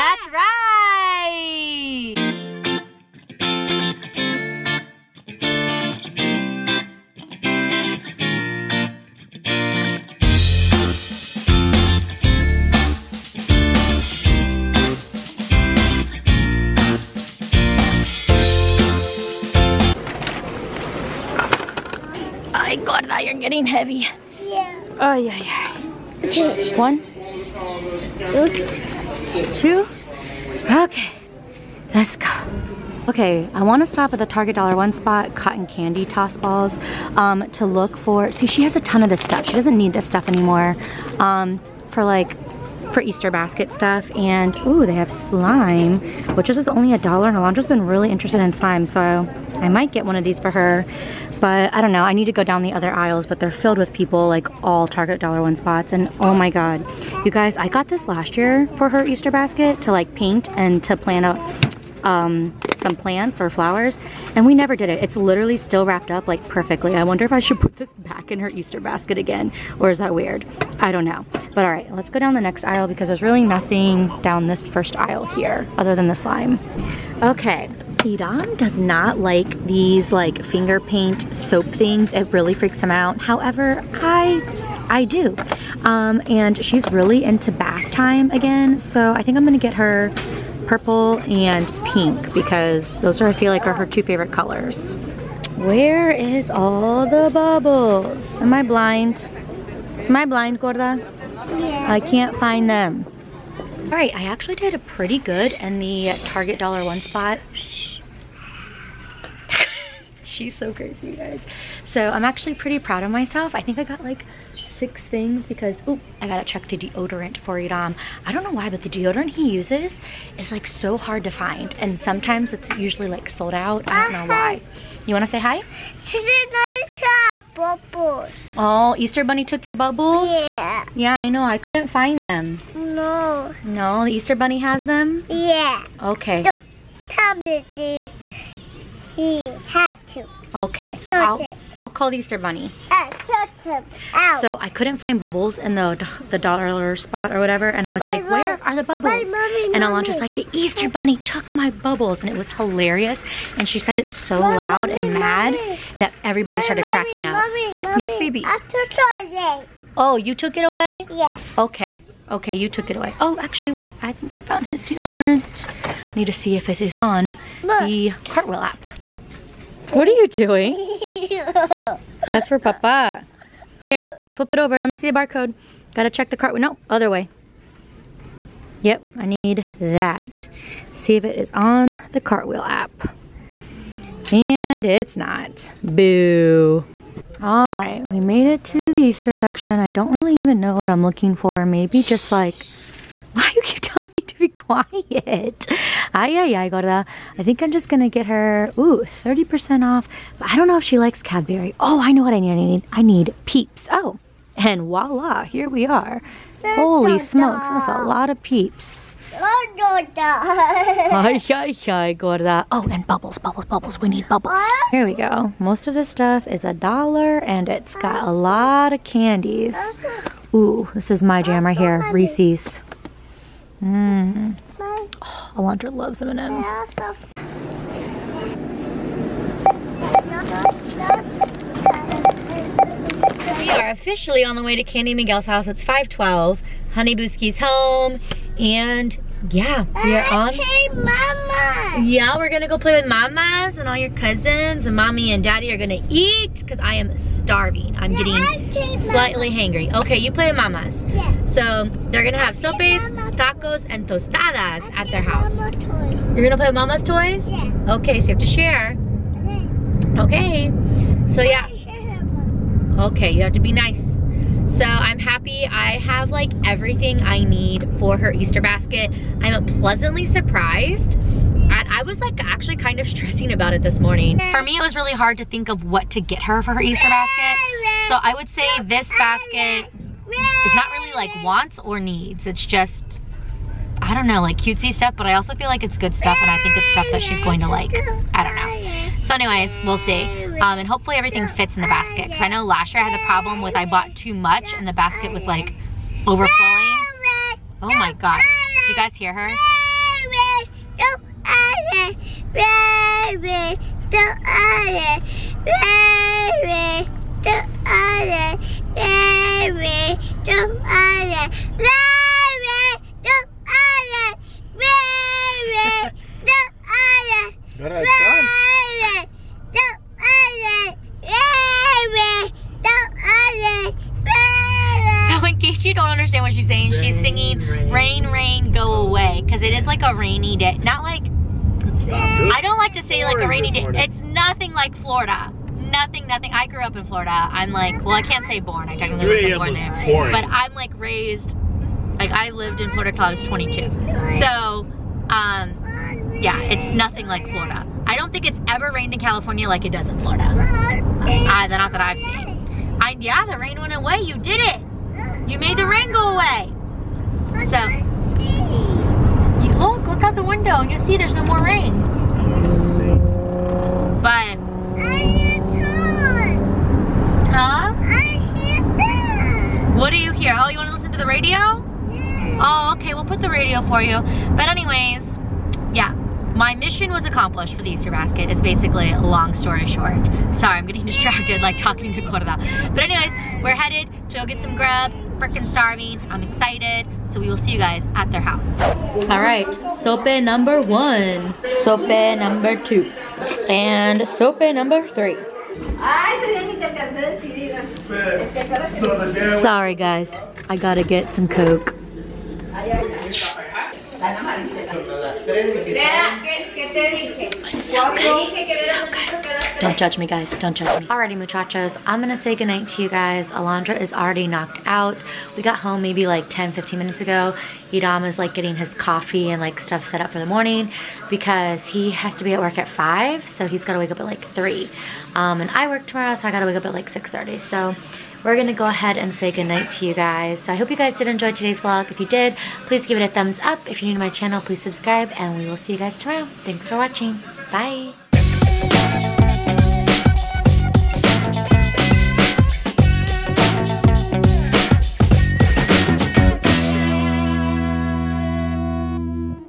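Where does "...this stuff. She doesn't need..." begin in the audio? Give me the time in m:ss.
0:39.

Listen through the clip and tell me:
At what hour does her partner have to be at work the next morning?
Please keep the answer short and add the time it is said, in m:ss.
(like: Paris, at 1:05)
5, at 7:02.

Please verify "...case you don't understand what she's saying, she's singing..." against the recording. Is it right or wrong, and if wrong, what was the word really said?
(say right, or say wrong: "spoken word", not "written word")
right.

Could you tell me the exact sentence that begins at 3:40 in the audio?
Ooh, this is my jam right here, Reese's.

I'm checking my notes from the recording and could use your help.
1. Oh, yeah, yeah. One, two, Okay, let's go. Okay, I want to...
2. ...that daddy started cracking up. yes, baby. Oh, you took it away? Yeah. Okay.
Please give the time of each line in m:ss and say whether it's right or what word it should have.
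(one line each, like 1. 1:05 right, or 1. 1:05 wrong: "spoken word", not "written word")
1. 0:24 right
2. 2:35 wrong: "everybody", not "daddy".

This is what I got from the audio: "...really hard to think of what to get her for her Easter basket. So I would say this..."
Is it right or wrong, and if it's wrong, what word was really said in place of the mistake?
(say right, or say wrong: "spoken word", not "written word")
right.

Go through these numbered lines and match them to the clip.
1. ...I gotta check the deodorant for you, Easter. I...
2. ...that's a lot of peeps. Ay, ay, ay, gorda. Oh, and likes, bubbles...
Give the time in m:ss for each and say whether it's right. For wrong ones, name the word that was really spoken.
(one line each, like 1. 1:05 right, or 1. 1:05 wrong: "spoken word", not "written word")
1. 1:56 wrong: "Dom", not "Easter"
2. 3:27 wrong: "bubbles", not "likes".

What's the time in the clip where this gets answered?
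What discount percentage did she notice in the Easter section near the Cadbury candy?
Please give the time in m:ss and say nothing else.
3:19.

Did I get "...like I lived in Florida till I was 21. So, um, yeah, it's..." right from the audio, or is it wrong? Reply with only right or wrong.
wrong.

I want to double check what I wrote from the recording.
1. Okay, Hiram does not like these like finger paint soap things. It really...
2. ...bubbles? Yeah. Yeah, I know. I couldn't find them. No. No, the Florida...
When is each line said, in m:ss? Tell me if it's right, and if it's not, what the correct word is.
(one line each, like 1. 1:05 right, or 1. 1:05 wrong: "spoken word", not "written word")
1. 1:17 right
2. 2:09 wrong: "Easter", not "Florida".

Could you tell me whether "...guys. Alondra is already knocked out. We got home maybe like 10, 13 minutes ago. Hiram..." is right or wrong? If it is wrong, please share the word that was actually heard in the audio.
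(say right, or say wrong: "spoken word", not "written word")
wrong: "15", not "13".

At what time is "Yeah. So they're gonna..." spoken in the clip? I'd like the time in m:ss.
4:11.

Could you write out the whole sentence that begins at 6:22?
But anyways, we're headed to go get some grub.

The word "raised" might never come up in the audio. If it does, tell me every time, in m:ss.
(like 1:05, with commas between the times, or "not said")
5:40.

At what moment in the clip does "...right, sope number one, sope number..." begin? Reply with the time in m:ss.
6:29.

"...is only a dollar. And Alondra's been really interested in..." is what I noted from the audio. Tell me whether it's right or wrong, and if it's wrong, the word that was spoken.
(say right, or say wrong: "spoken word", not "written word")
right.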